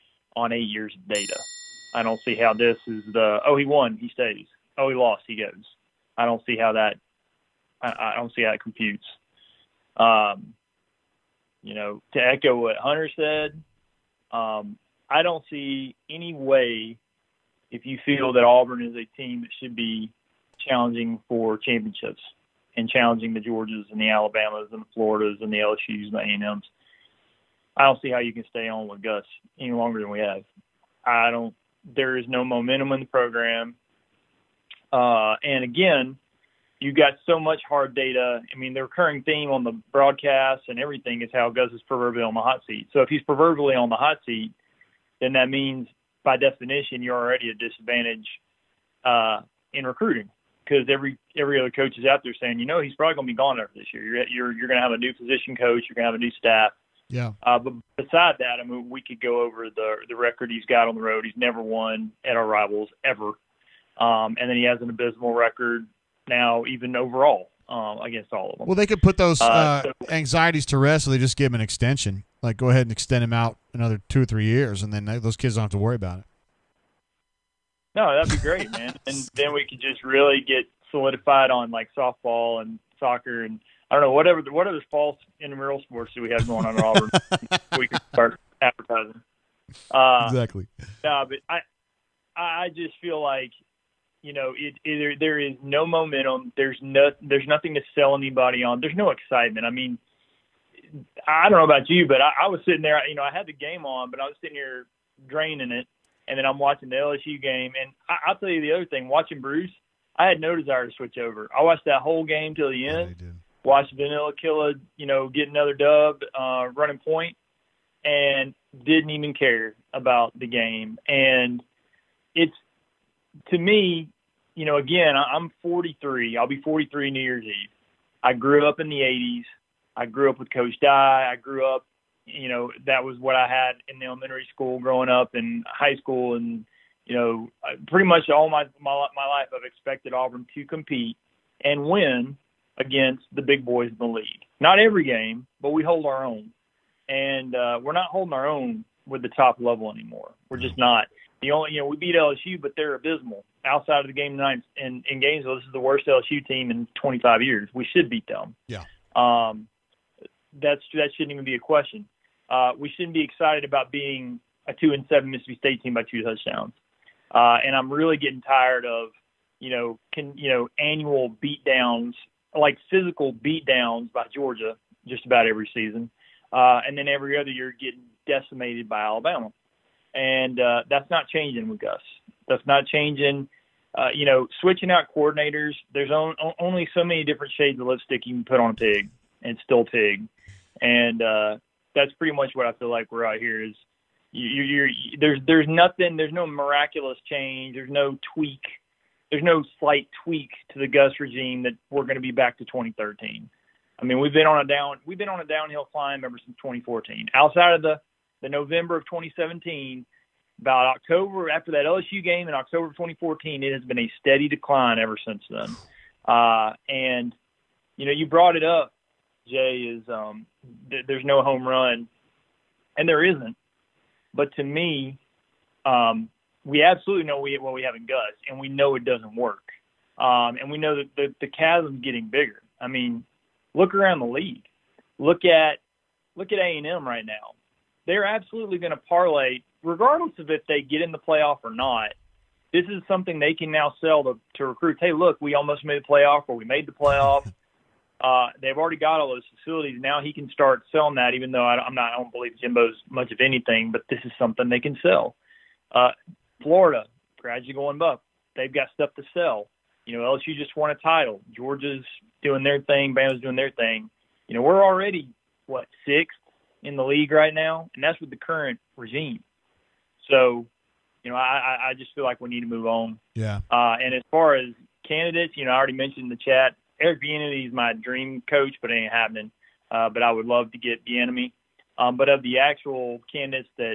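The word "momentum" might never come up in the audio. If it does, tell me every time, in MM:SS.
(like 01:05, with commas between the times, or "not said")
00:32, 01:35.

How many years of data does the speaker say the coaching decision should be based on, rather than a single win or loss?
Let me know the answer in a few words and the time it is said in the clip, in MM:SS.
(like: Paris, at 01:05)
8, at 00:00.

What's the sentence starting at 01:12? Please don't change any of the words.
Like, go ahead and extend them out another two or three years, and then those kids don't have to worry about it.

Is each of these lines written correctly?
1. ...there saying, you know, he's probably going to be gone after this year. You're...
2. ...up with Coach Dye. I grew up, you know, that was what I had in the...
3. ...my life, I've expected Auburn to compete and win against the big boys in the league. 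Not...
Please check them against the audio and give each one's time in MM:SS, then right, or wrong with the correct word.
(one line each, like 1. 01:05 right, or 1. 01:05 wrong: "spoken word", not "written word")
1. 00:52 right
2. 02:10 right
3. 02:19 right.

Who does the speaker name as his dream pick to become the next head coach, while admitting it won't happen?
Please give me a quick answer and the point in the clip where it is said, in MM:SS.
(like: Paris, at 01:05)
Eric Bieniemy, at 04:37.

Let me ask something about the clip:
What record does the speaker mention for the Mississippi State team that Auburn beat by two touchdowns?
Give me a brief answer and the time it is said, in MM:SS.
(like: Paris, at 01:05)
2-7, at 02:44.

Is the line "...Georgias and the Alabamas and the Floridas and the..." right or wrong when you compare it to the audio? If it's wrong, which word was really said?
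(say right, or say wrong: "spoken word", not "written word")
right.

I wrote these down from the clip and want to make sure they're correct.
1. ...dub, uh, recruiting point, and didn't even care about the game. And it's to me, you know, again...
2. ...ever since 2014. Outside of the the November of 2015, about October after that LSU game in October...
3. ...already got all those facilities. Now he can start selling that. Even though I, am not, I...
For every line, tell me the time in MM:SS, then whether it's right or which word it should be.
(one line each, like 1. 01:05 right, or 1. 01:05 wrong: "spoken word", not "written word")
1. 01:55 wrong: "running", not "recruiting"
2. 03:26 wrong: "2017", not "2015"
3. 04:08 right.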